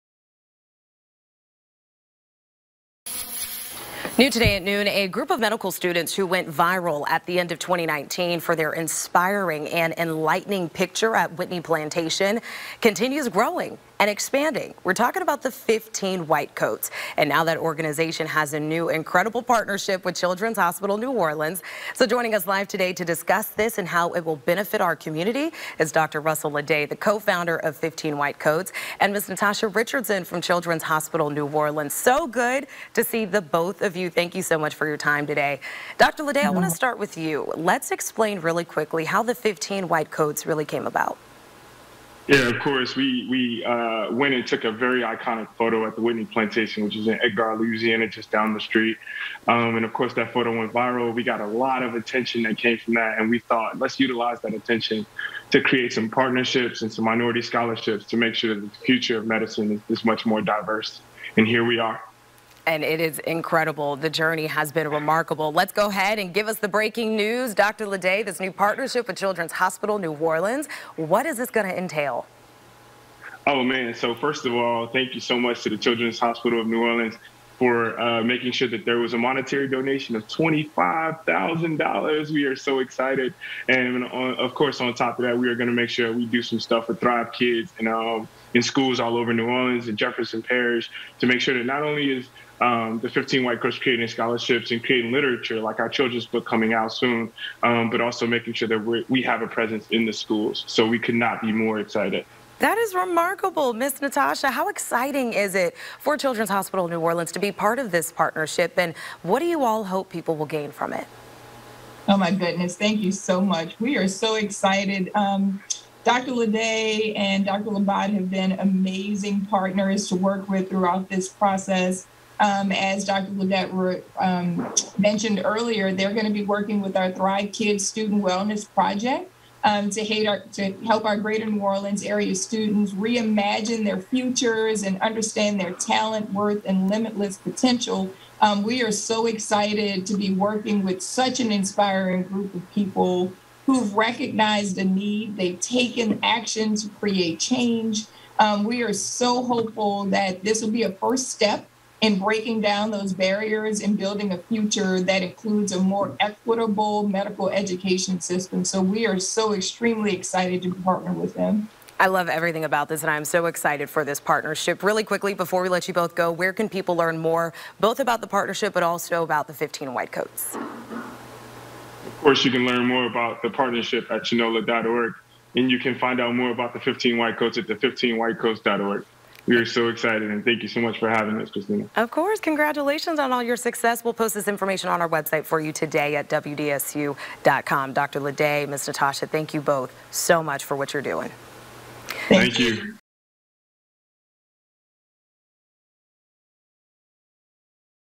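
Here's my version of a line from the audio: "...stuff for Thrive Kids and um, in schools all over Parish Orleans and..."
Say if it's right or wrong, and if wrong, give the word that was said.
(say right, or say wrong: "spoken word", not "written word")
wrong: "New", not "Parish".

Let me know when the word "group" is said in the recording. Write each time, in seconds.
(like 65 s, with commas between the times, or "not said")
5 s, 142 s.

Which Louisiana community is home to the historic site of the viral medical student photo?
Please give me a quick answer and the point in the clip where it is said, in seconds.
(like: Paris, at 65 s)
Edgard, at 47 s.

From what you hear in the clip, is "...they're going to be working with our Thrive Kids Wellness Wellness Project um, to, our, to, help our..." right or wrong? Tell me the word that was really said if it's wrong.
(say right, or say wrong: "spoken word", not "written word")
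wrong: "Student", not "Wellness".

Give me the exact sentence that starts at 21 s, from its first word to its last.
So joining us live today to discuss this and how it will benefit our community is Dr.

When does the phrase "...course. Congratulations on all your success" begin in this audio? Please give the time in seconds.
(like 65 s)
182 s.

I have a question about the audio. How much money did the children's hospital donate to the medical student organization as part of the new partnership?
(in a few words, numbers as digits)
$25,000.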